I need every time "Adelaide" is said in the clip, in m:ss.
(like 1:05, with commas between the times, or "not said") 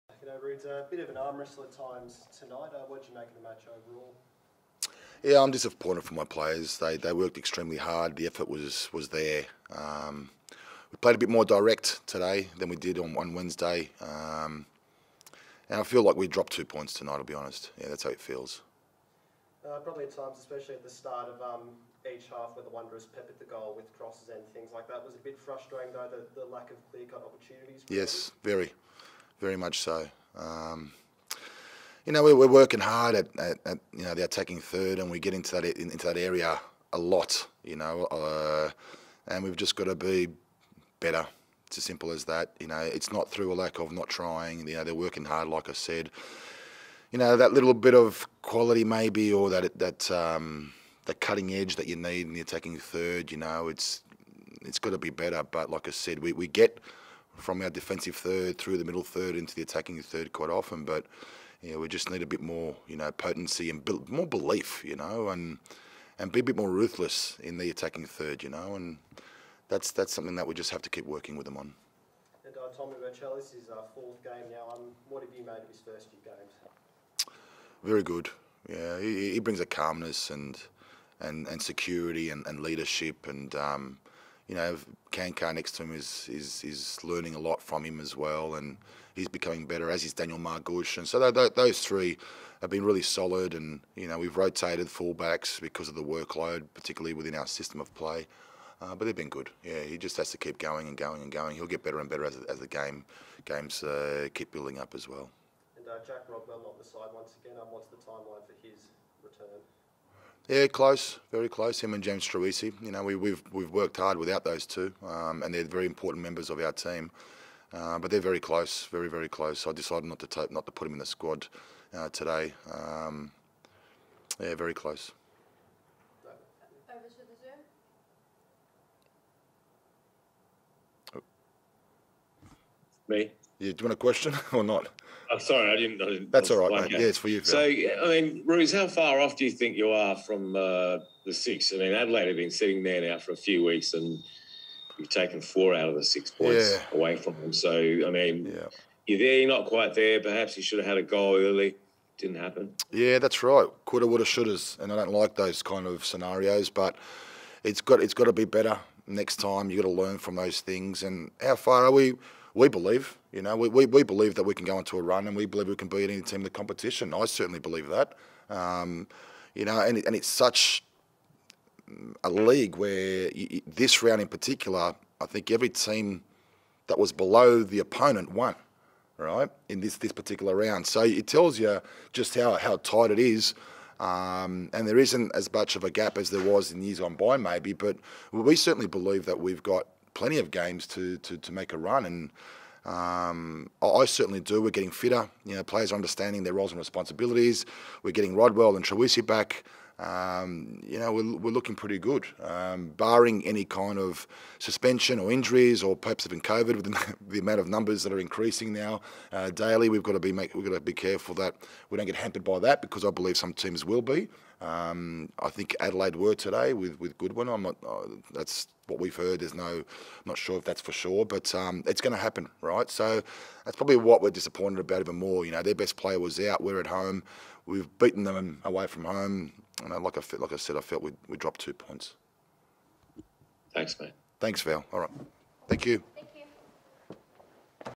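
2:21, 3:35.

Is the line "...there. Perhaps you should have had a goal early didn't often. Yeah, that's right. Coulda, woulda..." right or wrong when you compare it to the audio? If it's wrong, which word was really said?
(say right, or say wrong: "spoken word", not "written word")
wrong: "happen", not "often".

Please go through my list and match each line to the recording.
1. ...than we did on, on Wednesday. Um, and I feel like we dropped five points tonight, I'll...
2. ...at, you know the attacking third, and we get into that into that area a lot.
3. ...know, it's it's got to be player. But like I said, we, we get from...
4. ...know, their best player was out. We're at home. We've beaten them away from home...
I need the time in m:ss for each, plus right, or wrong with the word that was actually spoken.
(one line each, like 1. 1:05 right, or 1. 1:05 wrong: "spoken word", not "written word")
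1. 0:12 wrong: "two", not "five"
2. 0:33 right
3. 0:53 wrong: "better", not "player"
4. 3:45 right.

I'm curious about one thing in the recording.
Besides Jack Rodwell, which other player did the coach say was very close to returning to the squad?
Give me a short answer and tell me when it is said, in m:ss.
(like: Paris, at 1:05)
James Troisi, at 1:52.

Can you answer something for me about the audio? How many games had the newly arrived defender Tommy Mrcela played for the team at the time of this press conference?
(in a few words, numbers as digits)
4.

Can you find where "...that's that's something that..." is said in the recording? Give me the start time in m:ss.
1:09.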